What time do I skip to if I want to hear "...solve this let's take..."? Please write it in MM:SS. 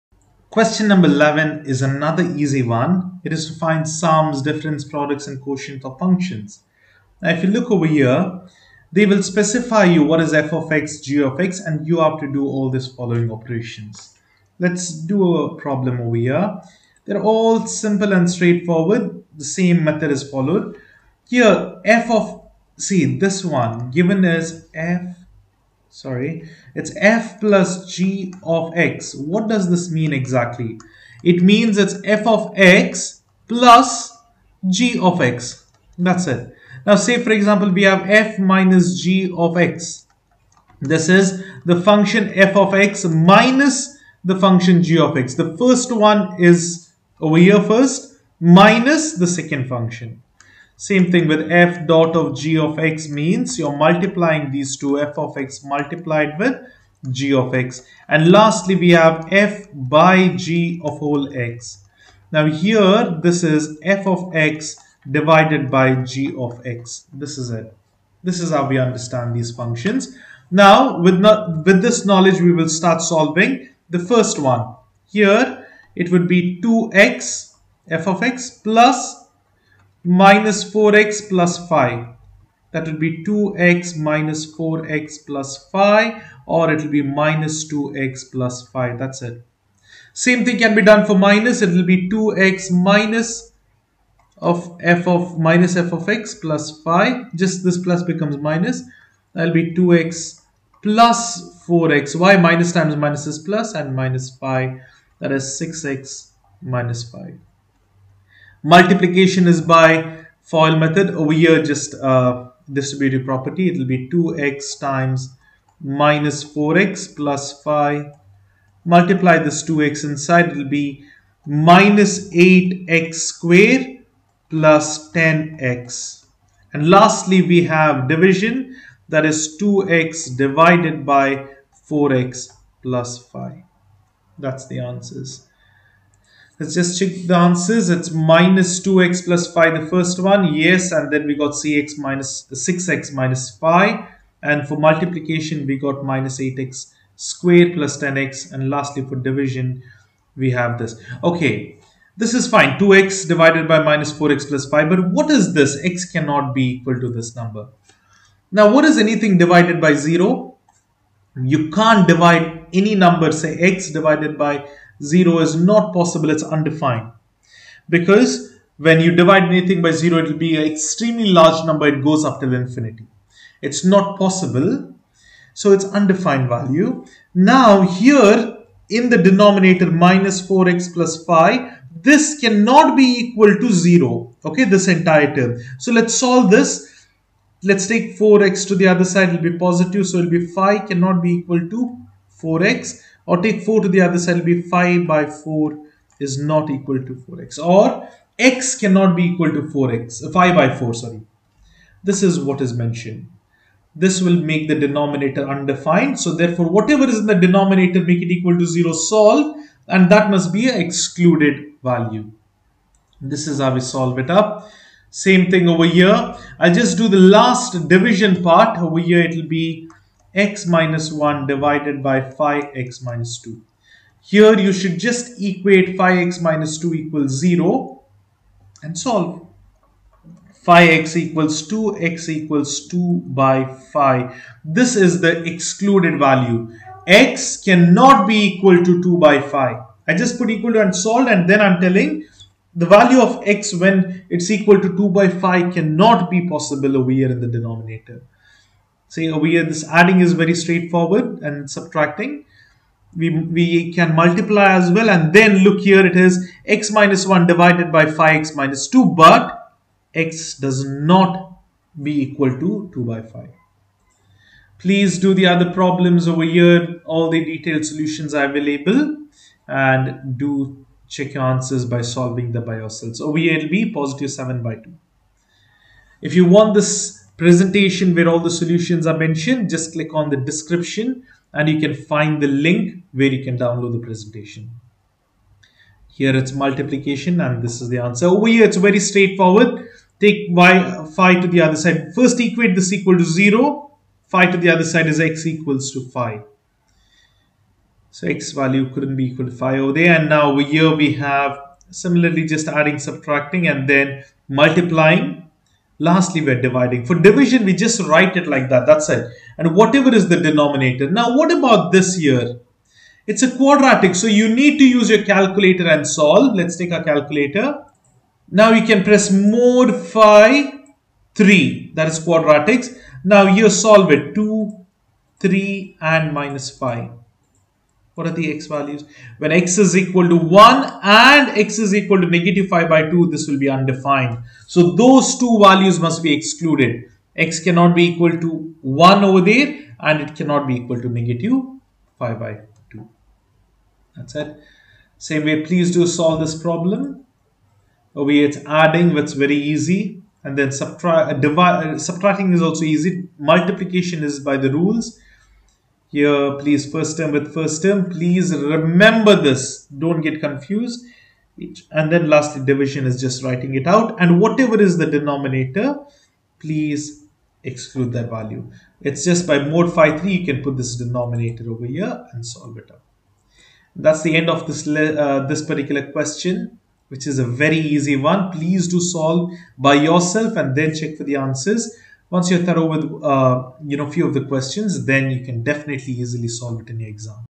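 03:06.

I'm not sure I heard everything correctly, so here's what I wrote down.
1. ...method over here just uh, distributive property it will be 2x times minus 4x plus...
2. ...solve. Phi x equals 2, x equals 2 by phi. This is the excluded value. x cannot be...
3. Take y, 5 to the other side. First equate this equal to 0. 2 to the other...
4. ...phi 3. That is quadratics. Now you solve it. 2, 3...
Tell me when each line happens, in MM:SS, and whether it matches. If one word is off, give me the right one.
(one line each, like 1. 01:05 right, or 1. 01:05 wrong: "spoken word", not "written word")
1. 01:50 right
2. 03:48 right
3. 04:50 wrong: "5", not "2"
4. 05:19 right.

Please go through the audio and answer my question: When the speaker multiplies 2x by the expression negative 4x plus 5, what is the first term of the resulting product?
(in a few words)
-8x squared.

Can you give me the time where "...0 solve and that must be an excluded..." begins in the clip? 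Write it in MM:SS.
03:28.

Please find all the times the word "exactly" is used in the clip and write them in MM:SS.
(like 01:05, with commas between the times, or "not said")
00:30.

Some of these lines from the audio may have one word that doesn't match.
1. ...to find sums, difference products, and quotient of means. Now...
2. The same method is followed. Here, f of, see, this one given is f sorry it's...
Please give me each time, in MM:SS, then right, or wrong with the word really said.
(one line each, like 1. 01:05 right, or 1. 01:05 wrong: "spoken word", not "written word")
1. 00:03 wrong: "functions", not "means"
2. 00:19 right.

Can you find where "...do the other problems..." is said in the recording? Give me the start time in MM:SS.
04:25.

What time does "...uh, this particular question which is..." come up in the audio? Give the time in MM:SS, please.
06:14.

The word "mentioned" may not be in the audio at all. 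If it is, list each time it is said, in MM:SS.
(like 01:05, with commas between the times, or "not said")
03:22, 04:39.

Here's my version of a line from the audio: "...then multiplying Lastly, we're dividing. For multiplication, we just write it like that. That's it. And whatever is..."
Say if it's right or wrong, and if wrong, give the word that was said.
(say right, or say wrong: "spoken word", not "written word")
wrong: "division", not "multiplication".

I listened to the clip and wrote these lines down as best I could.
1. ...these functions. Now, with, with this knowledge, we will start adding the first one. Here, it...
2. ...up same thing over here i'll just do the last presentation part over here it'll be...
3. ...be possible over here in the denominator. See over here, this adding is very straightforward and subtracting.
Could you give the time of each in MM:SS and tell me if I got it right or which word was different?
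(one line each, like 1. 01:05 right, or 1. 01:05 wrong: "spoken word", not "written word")
1. 01:09 wrong: "solving", not "adding"
2. 03:34 wrong: "division", not "presentation"
3. 04:06 right.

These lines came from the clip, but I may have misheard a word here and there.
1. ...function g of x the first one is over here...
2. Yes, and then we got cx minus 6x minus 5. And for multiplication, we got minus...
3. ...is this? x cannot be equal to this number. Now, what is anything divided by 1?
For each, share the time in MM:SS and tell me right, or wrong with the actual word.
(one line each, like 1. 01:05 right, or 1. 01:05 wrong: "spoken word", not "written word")
1. 00:44 right
2. 02:20 right
3. 02:35 wrong: "0", not "1".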